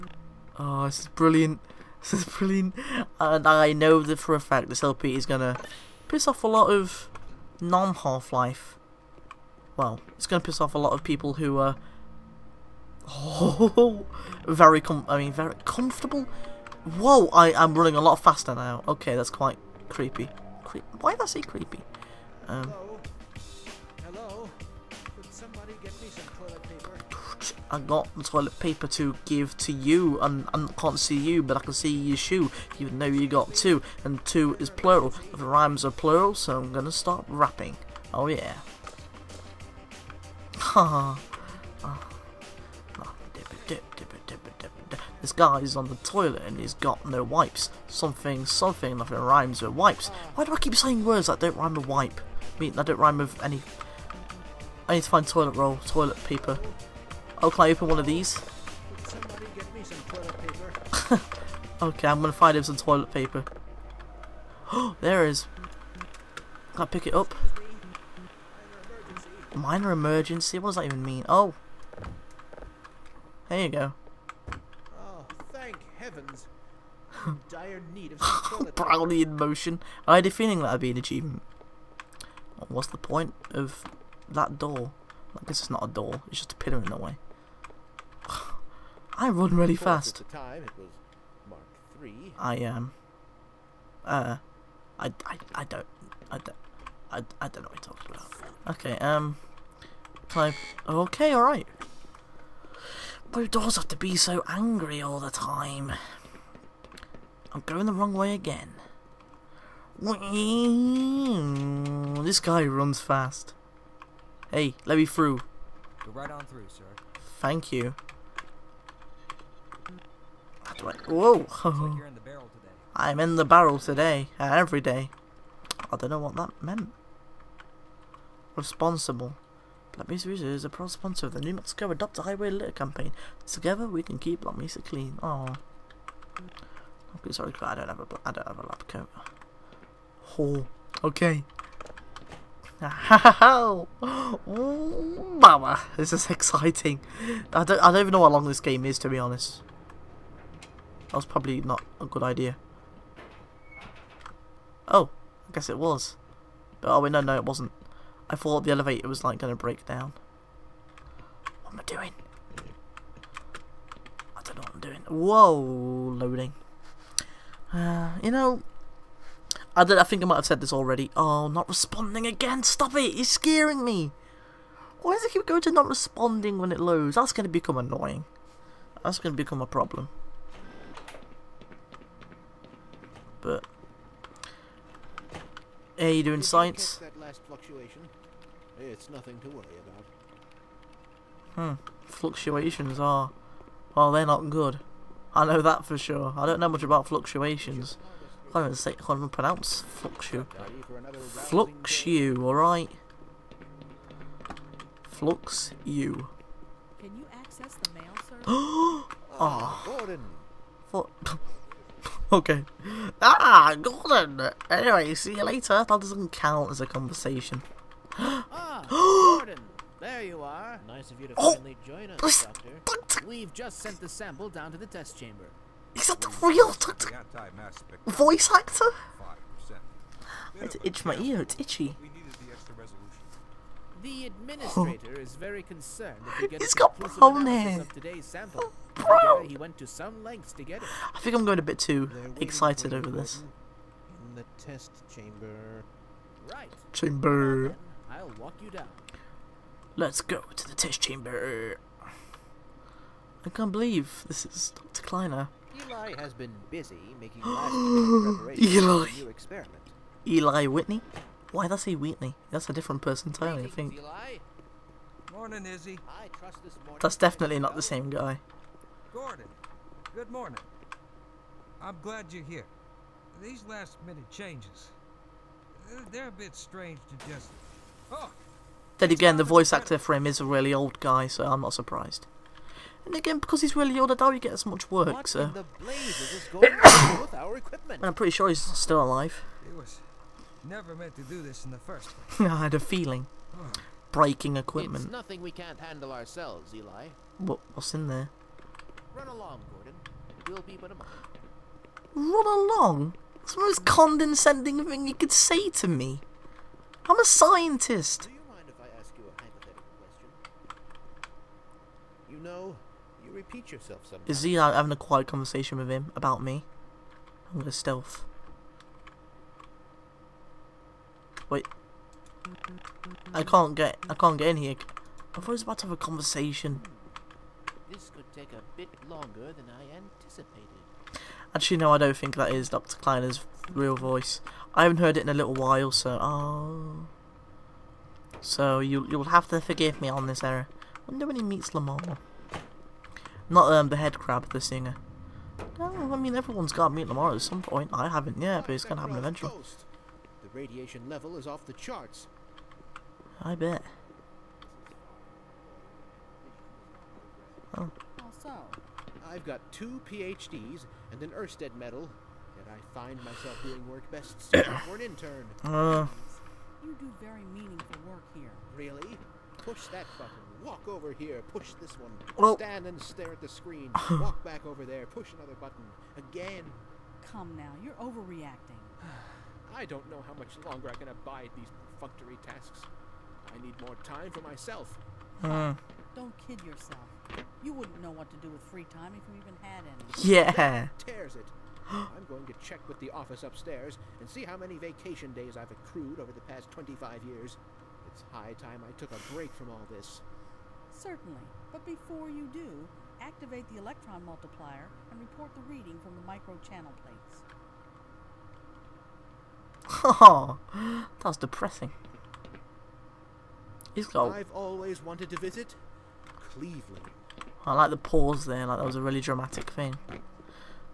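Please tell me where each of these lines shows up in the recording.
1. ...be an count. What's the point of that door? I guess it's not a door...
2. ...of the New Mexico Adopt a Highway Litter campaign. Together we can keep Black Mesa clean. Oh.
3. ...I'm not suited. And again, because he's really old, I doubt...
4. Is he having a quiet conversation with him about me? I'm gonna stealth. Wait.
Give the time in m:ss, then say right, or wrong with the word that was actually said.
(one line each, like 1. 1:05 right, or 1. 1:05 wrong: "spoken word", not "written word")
1. 1:20 wrong: "achievement", not "count"
2. 2:11 right
3. 4:41 wrong: "surprised", not "suited"
4. 5:14 right.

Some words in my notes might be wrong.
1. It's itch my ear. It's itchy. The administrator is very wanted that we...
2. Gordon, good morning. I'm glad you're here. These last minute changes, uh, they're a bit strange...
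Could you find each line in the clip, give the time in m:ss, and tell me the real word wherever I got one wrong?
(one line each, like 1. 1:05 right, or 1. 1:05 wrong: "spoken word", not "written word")
1. 3:50 wrong: "concerned", not "wanted"
2. 4:29 right.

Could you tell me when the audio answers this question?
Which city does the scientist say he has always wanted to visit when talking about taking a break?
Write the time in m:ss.
6:56.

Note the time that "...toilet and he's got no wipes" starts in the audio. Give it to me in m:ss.
0:46.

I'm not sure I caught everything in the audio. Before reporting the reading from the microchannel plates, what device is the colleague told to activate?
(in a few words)
electron multiplier.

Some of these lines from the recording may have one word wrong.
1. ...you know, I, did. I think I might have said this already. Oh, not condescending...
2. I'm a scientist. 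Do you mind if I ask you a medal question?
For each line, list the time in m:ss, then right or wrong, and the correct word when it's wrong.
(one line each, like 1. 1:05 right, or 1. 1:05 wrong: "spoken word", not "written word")
1. 2:48 wrong: "responding", not "condescending"
2. 5:07 wrong: "hypothetical", not "medal".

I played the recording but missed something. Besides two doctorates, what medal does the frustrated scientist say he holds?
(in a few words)
Oersted medal.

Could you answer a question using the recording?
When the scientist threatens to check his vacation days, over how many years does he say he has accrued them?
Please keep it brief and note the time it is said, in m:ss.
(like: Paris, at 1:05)
25, at 6:36.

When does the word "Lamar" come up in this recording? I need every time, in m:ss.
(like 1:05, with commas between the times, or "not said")
5:41, 5:47.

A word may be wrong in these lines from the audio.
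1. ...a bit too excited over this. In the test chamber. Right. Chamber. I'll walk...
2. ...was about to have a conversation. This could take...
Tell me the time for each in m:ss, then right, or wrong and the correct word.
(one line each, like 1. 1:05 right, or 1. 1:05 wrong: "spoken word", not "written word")
1. 4:01 right
2. 5:25 right.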